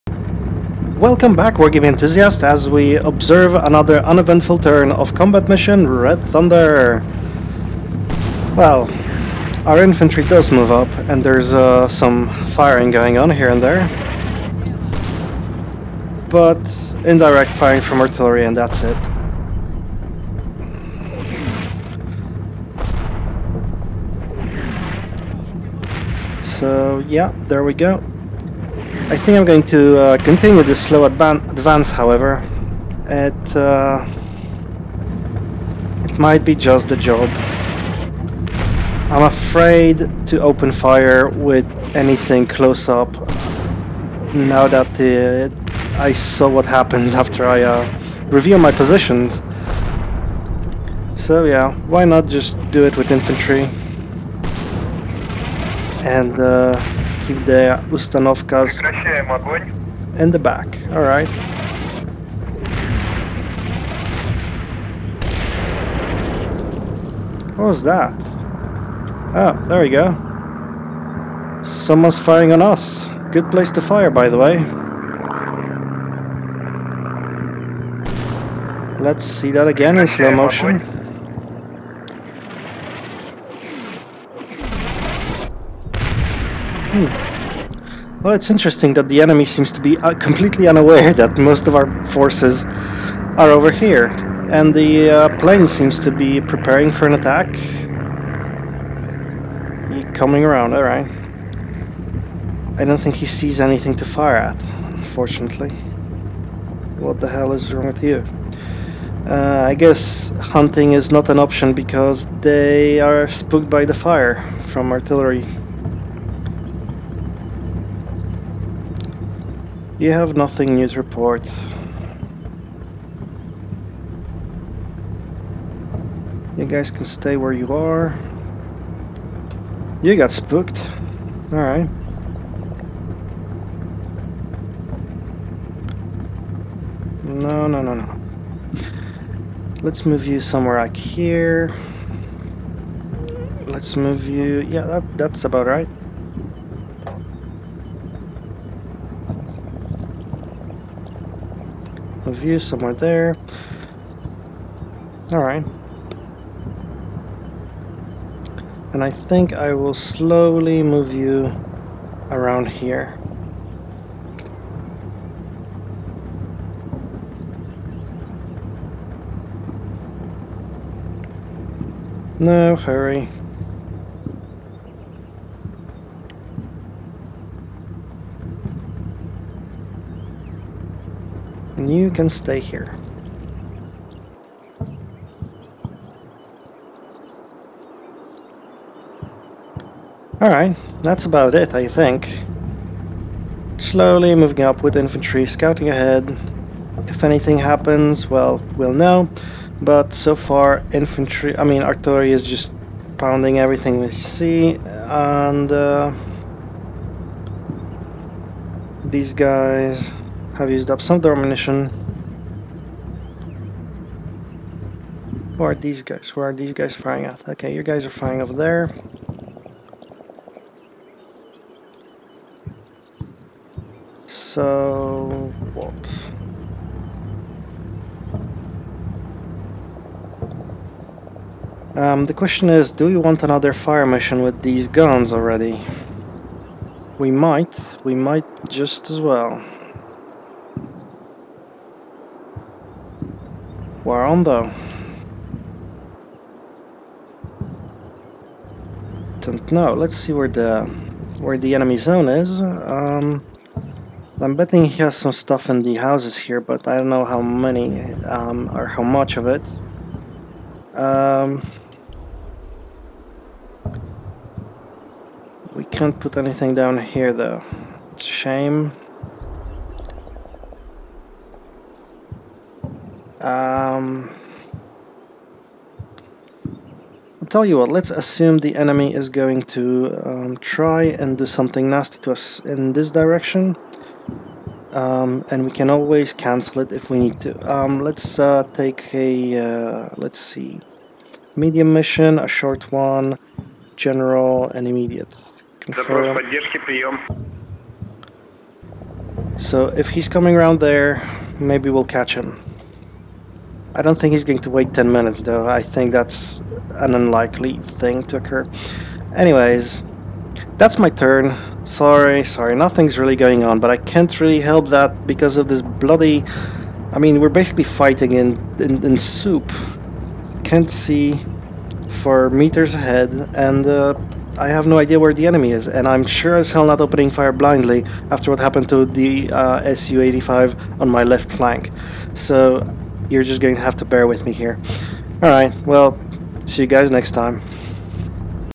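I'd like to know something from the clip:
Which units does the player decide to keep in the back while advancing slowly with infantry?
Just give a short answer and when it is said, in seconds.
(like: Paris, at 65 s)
Ustanovkas, at 57 s.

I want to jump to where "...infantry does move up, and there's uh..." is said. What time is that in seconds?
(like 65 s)
9 s.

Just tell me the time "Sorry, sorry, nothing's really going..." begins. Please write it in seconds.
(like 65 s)
311 s.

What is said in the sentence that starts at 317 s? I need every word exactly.
I mean, we're basically fighting in, in, in soup.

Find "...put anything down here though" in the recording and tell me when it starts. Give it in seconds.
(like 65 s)
266 s.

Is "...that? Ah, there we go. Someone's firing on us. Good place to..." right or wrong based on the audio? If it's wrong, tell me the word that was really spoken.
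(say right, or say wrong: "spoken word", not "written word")
right.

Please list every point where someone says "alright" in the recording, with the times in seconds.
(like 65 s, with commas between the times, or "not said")
60 s, 100 s, 131 s, 155 s, 190 s, 335 s.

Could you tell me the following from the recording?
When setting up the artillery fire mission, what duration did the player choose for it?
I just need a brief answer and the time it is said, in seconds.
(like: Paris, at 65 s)
short, at 292 s.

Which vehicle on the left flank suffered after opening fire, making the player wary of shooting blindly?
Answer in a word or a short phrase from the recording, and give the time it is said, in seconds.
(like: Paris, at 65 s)
Su-85, at 329 s.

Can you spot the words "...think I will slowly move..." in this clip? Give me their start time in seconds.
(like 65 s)
159 s.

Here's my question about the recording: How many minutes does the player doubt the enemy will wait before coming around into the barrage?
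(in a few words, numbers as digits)
10.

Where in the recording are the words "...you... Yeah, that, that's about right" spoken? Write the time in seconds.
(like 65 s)
144 s.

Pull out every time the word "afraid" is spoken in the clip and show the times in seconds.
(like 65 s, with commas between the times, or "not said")
39 s.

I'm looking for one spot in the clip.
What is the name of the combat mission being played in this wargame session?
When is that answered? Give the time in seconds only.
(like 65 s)
5 s.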